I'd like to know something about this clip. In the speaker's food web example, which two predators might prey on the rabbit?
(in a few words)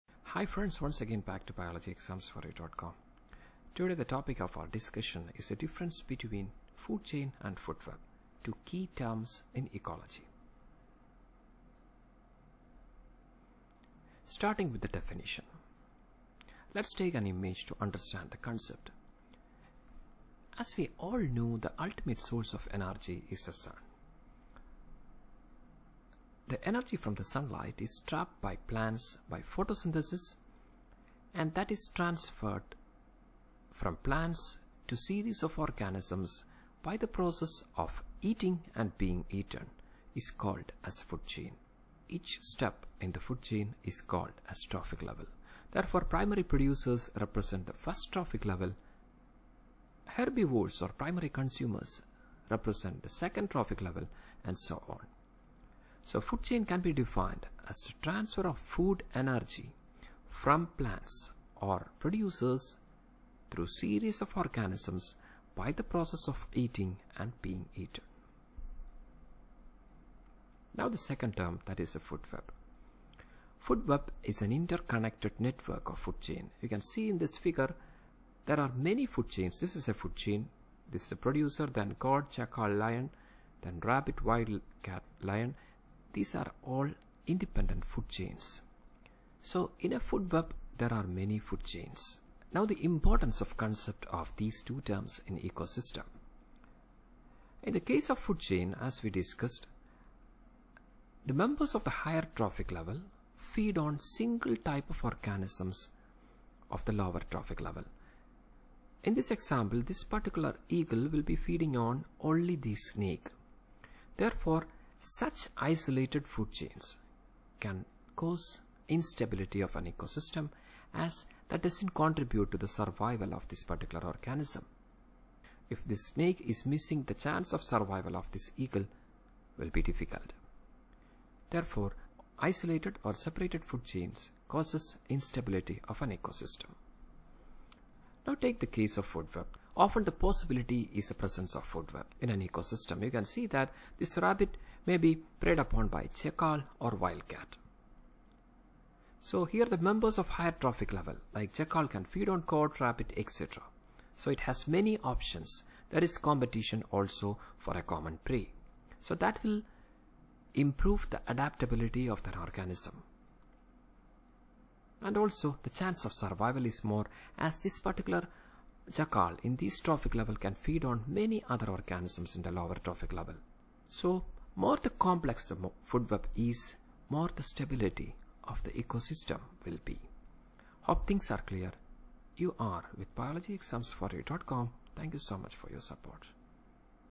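Jackal or wildcat.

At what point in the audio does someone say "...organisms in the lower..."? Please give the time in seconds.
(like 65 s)
171 s.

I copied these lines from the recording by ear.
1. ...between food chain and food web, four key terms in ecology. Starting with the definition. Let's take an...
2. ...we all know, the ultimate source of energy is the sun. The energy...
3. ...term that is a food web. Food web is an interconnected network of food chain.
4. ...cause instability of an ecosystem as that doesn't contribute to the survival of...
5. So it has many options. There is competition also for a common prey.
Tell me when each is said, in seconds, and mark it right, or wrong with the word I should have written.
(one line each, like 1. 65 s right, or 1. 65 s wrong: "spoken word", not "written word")
1. 5 s wrong: "two", not "four"
2. 20 s right
3. 71 s right
4. 118 s right
5. 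154 s right.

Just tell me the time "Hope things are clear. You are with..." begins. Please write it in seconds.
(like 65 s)
180 s.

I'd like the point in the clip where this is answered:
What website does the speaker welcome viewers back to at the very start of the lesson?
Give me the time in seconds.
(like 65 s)
1 s.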